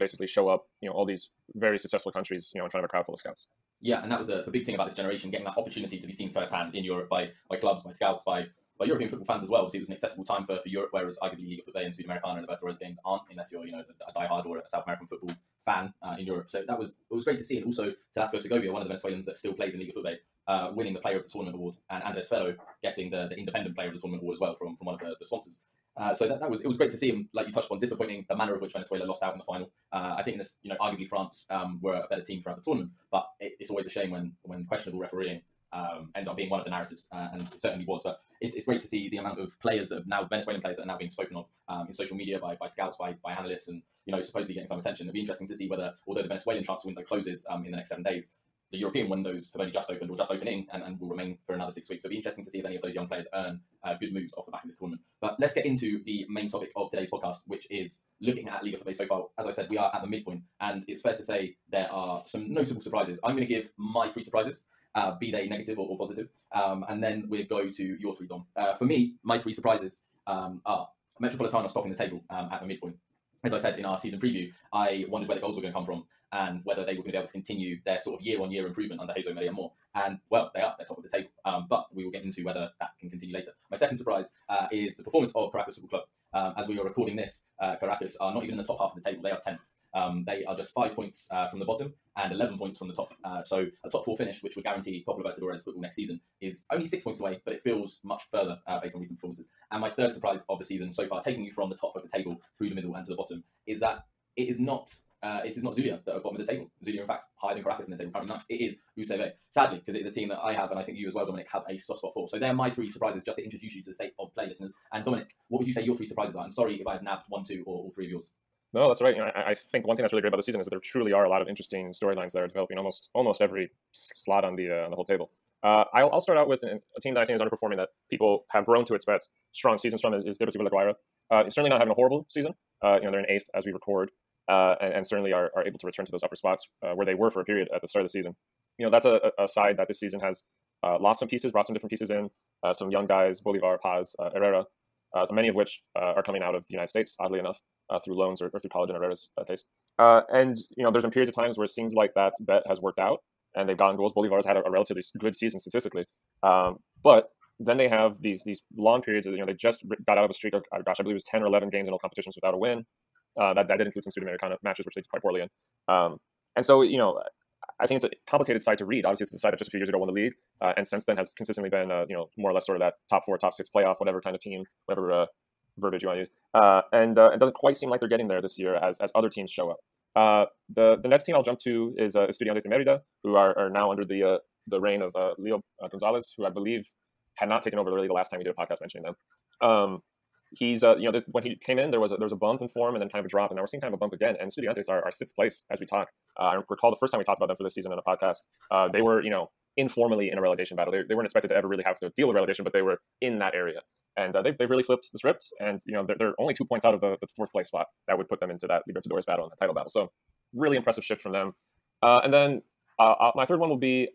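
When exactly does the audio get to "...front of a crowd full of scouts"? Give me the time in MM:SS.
00:02.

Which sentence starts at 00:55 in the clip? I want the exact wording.
But let's get into the main topic of today's podcast, which is looking at Liga FUTVE so far.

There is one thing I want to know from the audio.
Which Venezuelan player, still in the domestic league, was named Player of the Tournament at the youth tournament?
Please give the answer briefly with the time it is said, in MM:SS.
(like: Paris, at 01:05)
Telasco Segovia, at 00:18.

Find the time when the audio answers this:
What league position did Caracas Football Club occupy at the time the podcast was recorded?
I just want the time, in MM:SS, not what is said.
01:29.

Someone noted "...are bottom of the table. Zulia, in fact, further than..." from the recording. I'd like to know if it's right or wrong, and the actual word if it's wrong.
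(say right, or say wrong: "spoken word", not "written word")
wrong: "higher", not "further".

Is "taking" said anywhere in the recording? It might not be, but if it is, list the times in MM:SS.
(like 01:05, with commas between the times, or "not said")
01:41.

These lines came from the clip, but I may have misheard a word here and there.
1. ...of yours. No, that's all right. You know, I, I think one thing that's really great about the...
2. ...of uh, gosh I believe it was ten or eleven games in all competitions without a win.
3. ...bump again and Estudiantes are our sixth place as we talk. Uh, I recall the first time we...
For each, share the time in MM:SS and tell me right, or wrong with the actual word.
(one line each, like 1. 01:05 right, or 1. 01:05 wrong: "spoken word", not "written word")
1. 01:58 right
2. 02:40 right
3. 03:13 right.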